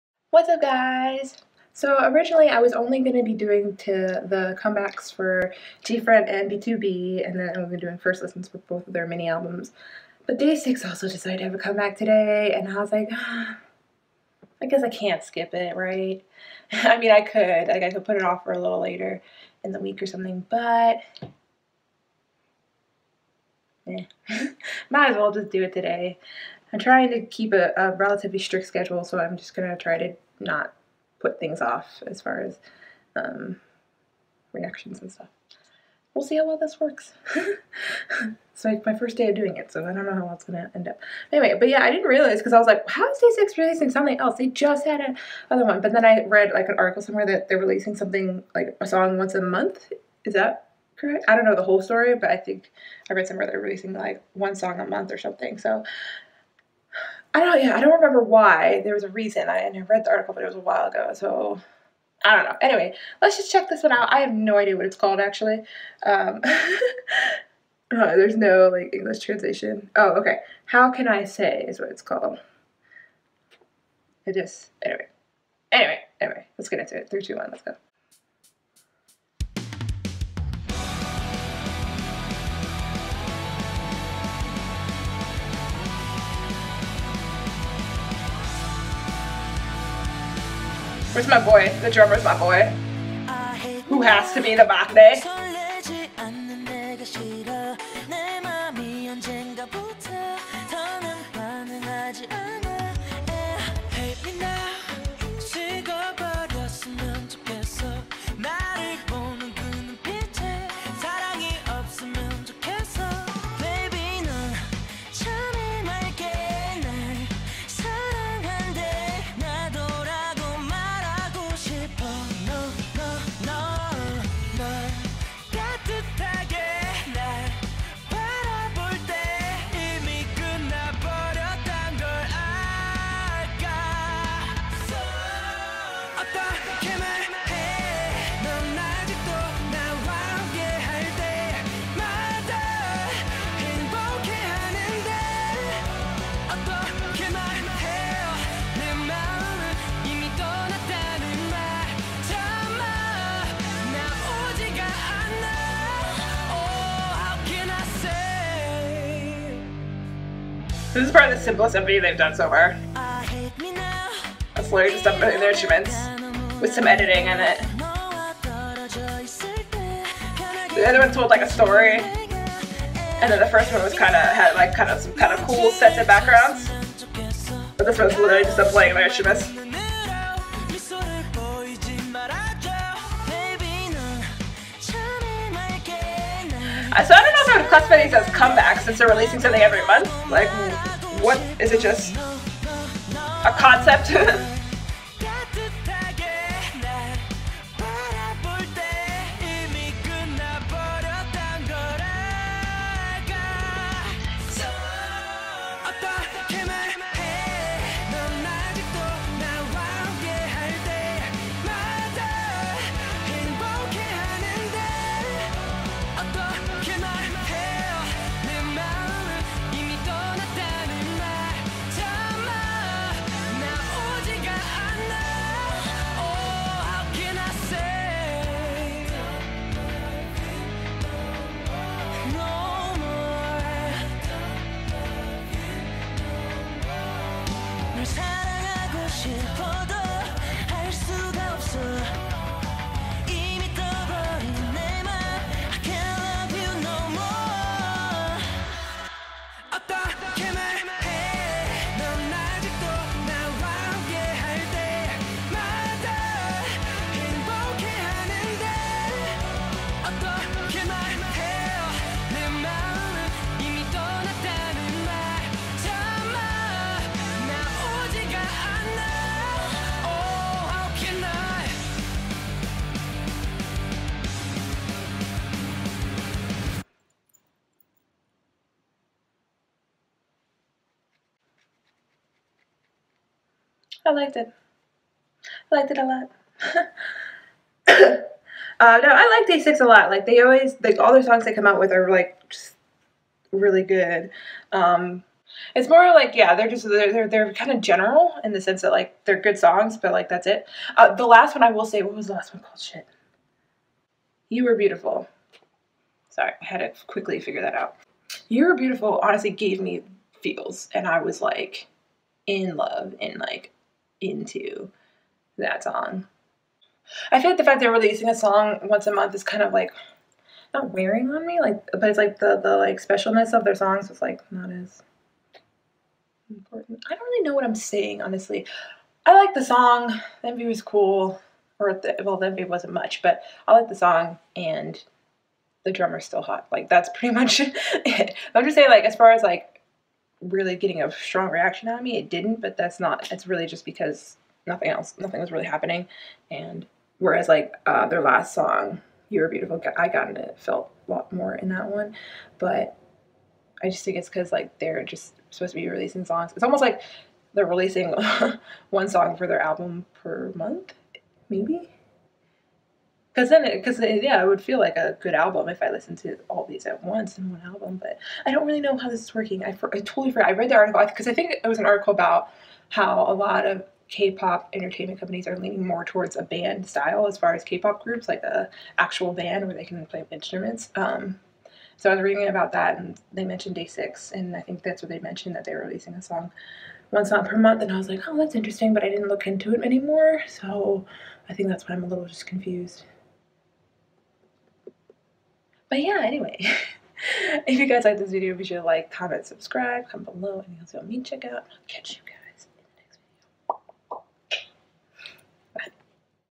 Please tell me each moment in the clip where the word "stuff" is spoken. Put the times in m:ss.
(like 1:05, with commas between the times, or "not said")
0:35.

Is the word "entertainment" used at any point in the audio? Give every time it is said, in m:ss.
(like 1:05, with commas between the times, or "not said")
6:14.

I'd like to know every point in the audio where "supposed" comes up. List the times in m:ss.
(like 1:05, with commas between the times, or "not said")
5:55.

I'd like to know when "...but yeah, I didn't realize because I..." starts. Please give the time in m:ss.
0:41.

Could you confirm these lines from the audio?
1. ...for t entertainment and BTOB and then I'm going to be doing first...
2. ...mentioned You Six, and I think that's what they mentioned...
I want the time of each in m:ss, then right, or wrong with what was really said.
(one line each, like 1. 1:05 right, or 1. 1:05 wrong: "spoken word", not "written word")
1. 0:05 wrong: "front", not "entertainment"
2. 6:23 wrong: "Day", not "You".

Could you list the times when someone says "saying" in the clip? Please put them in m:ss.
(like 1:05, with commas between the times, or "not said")
5:27, 5:38.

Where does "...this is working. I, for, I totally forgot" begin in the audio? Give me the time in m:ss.
6:09.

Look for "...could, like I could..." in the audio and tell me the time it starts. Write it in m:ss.
0:17.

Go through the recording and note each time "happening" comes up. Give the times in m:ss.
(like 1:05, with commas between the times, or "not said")
5:45.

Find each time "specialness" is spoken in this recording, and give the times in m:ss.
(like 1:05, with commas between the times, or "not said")
5:23.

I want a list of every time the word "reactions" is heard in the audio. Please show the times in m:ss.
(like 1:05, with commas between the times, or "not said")
0:34, 5:41.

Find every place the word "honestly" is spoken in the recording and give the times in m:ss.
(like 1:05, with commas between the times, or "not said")
5:09, 5:28.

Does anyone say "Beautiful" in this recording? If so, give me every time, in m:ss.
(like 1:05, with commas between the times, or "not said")
5:04, 5:08, 5:49.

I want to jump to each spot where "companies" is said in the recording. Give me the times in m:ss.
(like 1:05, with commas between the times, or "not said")
6:15.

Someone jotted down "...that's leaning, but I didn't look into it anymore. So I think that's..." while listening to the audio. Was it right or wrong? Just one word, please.
wrong.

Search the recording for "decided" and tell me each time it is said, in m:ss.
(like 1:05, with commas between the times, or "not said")
0:11.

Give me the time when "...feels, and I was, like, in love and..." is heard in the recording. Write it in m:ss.
5:10.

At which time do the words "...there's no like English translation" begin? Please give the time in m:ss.
1:08.